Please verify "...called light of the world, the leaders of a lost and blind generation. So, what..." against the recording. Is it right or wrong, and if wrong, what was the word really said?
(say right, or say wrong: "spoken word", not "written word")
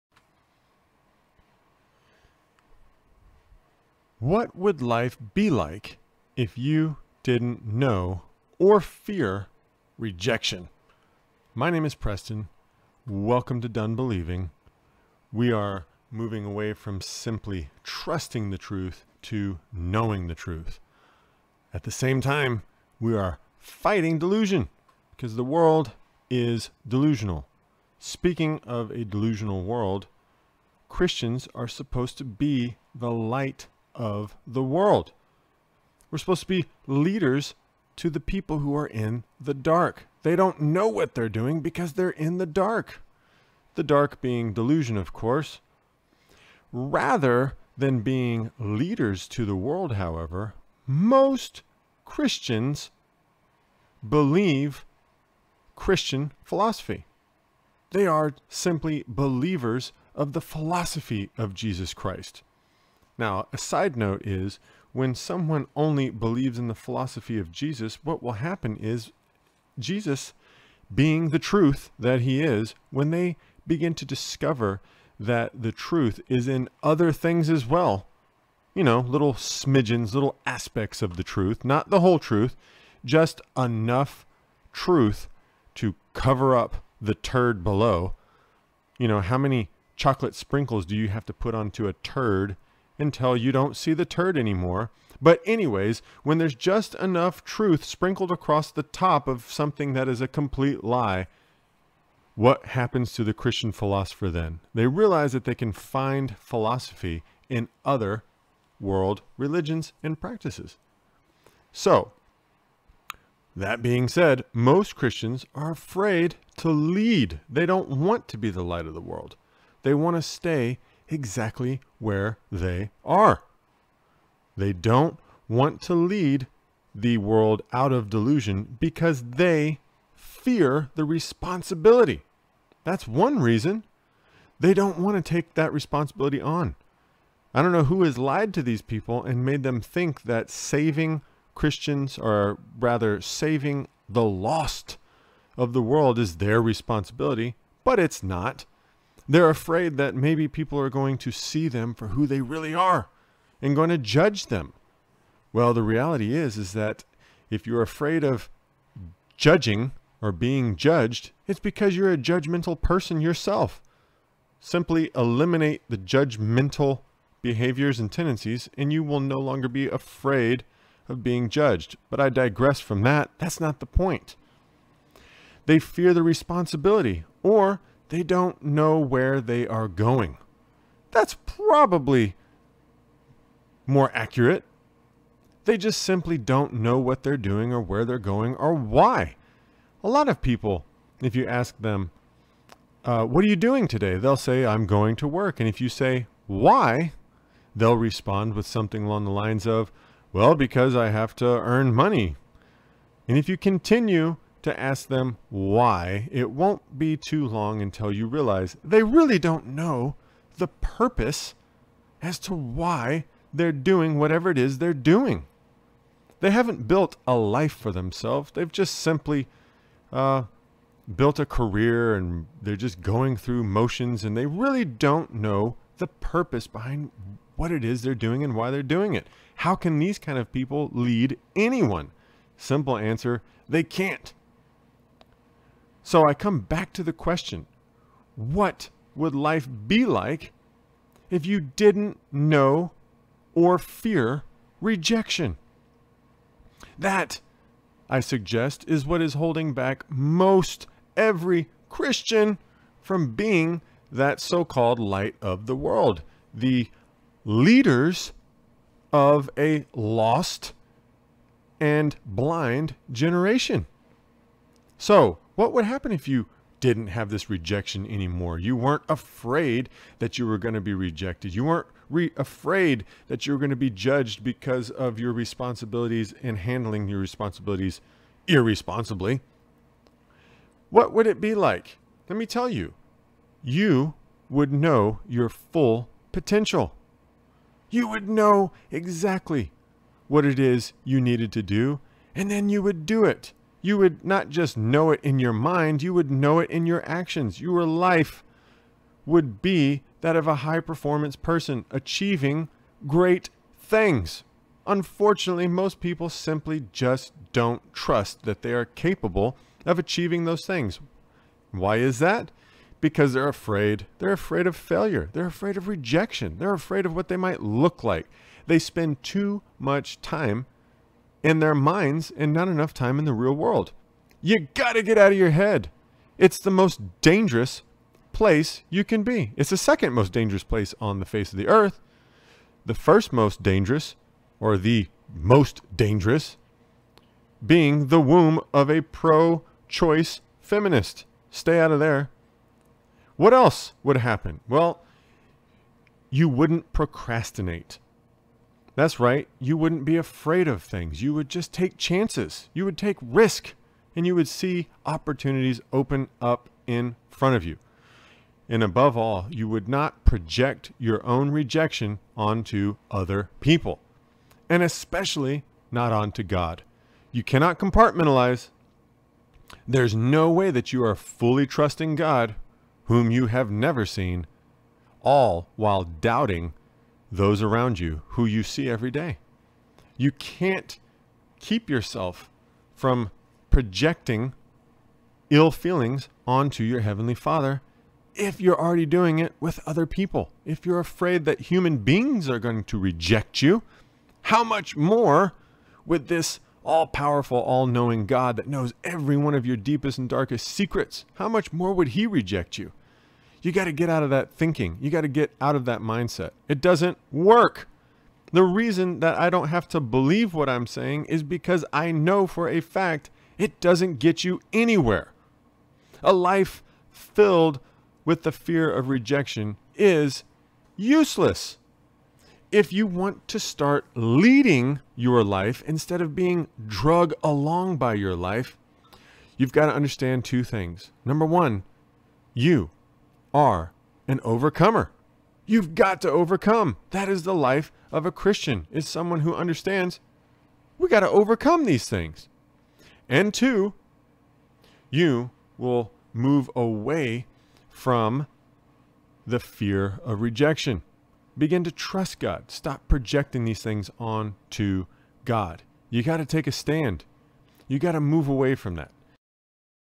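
right.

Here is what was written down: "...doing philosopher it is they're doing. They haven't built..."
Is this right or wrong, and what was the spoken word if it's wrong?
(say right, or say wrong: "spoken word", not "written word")
wrong: "whatever", not "philosopher".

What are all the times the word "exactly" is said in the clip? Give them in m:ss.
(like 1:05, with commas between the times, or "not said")
2:01, 4:48.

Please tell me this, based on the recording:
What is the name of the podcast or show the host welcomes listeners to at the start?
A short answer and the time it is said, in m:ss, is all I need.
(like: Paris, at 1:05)
Done Believing, at 0:13.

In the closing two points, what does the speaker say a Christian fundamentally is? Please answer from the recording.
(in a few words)
an overcomer.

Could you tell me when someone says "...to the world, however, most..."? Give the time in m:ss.
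0:49.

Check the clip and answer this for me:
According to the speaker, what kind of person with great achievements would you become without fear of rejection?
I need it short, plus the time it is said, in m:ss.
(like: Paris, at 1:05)
high performance person, at 5:00.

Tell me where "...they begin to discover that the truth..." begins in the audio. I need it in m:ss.
1:13.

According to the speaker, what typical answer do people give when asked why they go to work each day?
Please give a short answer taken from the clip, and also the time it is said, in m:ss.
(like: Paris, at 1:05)
to earn money, at 3:21.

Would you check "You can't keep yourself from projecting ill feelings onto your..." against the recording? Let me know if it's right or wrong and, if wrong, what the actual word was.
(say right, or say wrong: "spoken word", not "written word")
right.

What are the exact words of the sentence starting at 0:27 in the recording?
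Speaking of a delusional world, Christians are supposed to be the light of the world.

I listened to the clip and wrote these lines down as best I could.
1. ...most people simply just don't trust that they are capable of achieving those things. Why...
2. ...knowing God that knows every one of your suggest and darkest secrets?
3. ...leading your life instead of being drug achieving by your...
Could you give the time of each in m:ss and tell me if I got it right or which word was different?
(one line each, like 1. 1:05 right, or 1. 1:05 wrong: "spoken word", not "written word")
1. 5:05 right
2. 6:37 wrong: "deepest", not "suggest"
3. 7:04 wrong: "along", not "achieving".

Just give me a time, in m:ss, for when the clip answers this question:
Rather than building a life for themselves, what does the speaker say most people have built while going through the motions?
3:41.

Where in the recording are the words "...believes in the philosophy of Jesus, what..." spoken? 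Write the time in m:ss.
1:06.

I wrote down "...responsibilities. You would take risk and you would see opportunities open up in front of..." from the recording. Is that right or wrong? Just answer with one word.
wrong.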